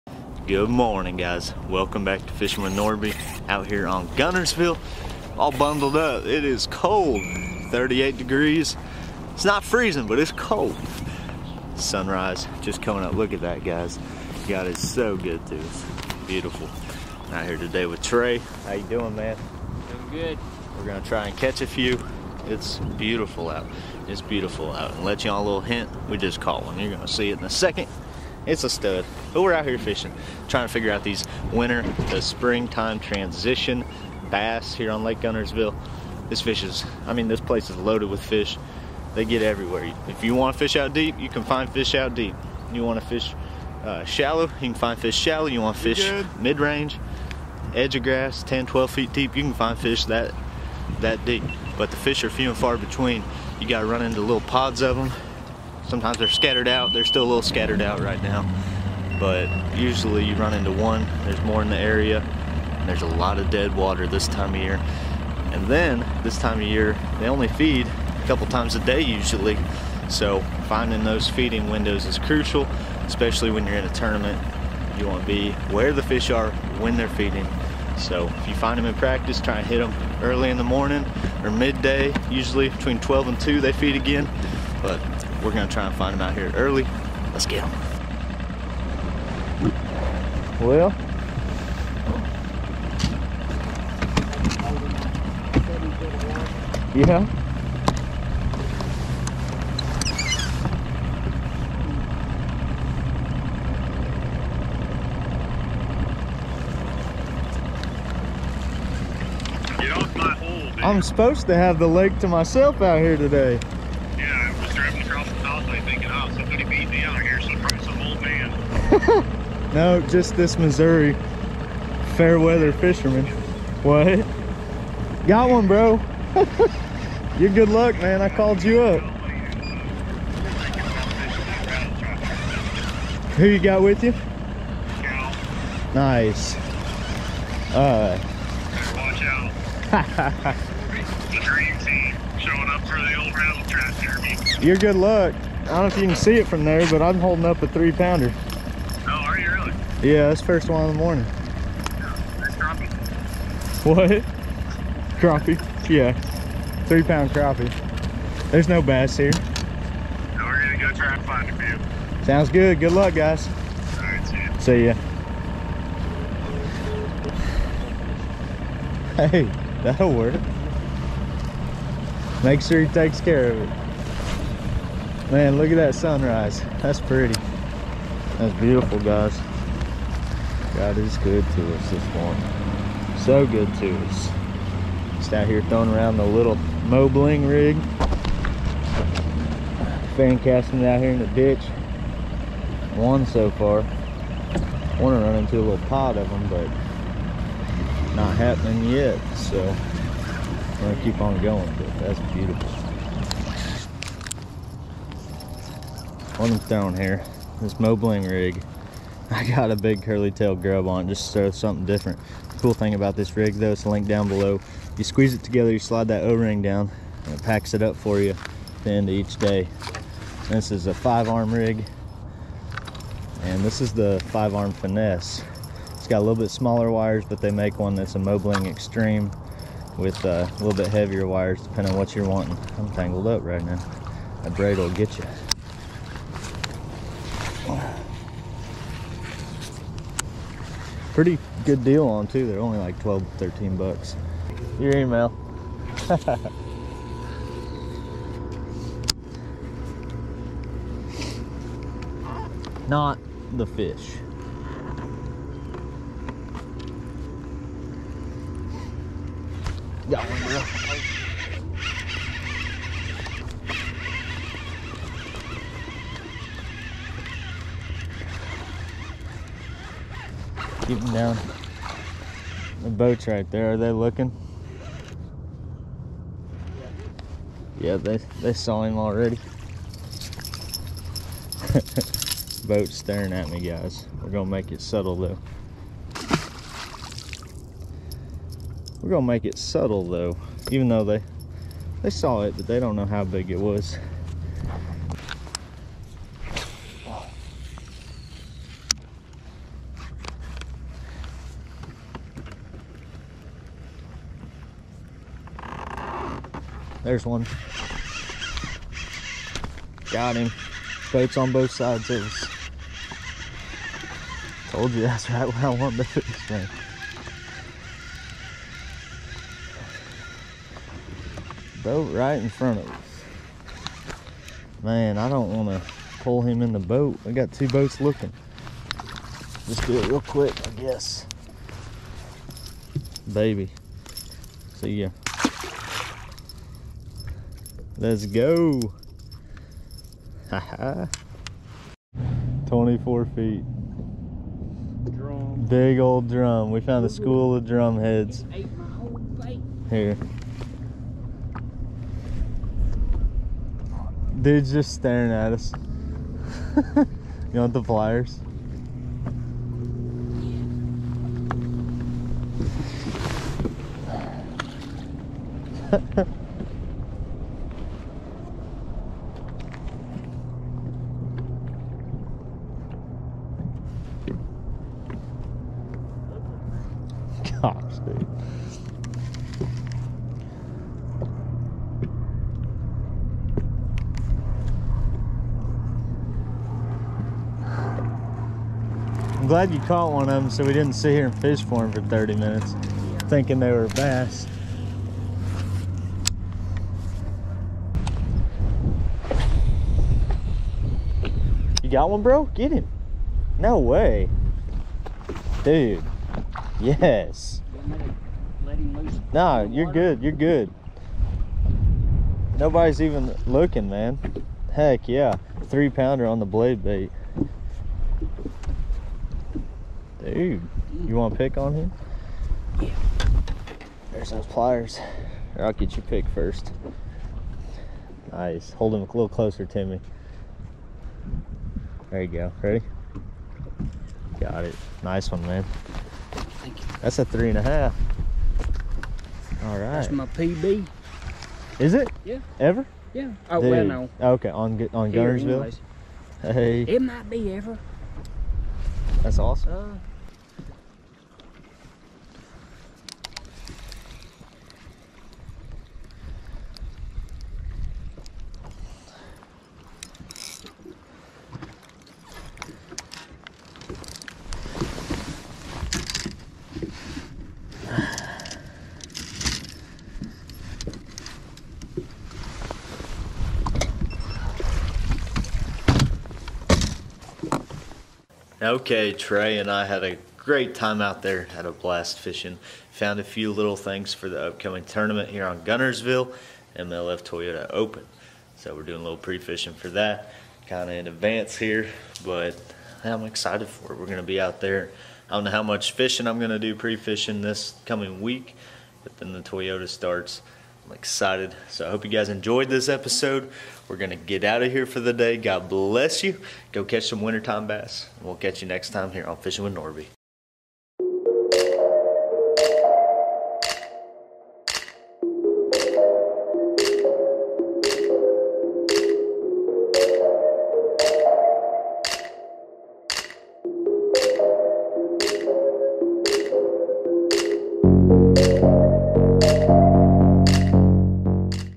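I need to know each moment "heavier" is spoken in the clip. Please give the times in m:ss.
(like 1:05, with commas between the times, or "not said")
3:50.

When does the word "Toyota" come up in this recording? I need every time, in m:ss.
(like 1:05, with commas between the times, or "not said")
8:07, 8:19.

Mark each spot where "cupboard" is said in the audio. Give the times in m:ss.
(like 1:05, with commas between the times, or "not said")
not said.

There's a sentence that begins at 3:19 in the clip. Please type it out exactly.
So I'm going to keep on going, but that's beautiful.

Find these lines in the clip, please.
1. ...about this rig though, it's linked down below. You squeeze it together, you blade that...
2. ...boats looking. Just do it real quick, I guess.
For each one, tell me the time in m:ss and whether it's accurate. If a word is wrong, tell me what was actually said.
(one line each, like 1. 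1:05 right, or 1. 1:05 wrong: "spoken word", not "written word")
1. 3:32 wrong: "slide", not "blade"
2. 5:27 right.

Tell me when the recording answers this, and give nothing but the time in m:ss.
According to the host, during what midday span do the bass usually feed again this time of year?
1:22.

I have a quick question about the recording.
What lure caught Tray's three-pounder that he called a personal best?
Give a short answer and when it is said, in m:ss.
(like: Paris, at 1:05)
Blade bait, at 6:56.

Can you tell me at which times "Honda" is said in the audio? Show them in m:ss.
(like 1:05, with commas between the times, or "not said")
not said.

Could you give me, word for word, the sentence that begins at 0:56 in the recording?
They're still a little scattered out right now.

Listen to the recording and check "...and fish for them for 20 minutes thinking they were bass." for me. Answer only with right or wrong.
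wrong.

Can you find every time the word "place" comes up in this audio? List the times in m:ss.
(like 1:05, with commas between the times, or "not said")
0:37.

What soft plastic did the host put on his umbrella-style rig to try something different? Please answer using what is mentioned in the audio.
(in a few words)
Big curly tail grub.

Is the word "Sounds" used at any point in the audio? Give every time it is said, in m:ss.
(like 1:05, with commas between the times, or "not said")
2:42.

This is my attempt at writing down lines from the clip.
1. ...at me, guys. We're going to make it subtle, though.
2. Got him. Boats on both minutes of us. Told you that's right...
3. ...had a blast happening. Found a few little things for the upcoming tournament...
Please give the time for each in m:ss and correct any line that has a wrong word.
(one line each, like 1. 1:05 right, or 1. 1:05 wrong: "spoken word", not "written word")
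1. 4:43 right
2. 5:10 wrong: "sides", not "minutes"
3. 8:01 wrong: "fishing", not "happening".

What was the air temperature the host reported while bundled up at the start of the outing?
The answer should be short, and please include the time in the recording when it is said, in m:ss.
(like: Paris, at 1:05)
38 degrees, at 0:07.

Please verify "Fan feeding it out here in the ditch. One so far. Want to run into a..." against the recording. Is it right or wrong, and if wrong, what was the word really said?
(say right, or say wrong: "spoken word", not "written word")
wrong: "casting", not "feeding".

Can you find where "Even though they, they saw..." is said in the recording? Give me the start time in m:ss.
4:50.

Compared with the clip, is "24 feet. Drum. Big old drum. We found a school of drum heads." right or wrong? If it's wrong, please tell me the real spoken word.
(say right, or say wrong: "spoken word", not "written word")
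right.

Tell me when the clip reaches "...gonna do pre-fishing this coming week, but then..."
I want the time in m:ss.
8:16.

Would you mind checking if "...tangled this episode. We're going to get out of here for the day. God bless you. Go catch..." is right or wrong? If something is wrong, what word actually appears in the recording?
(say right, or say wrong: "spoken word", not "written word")
wrong: "enjoyed", not "tangled".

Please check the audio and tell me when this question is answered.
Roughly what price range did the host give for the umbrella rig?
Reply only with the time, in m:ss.
4:02.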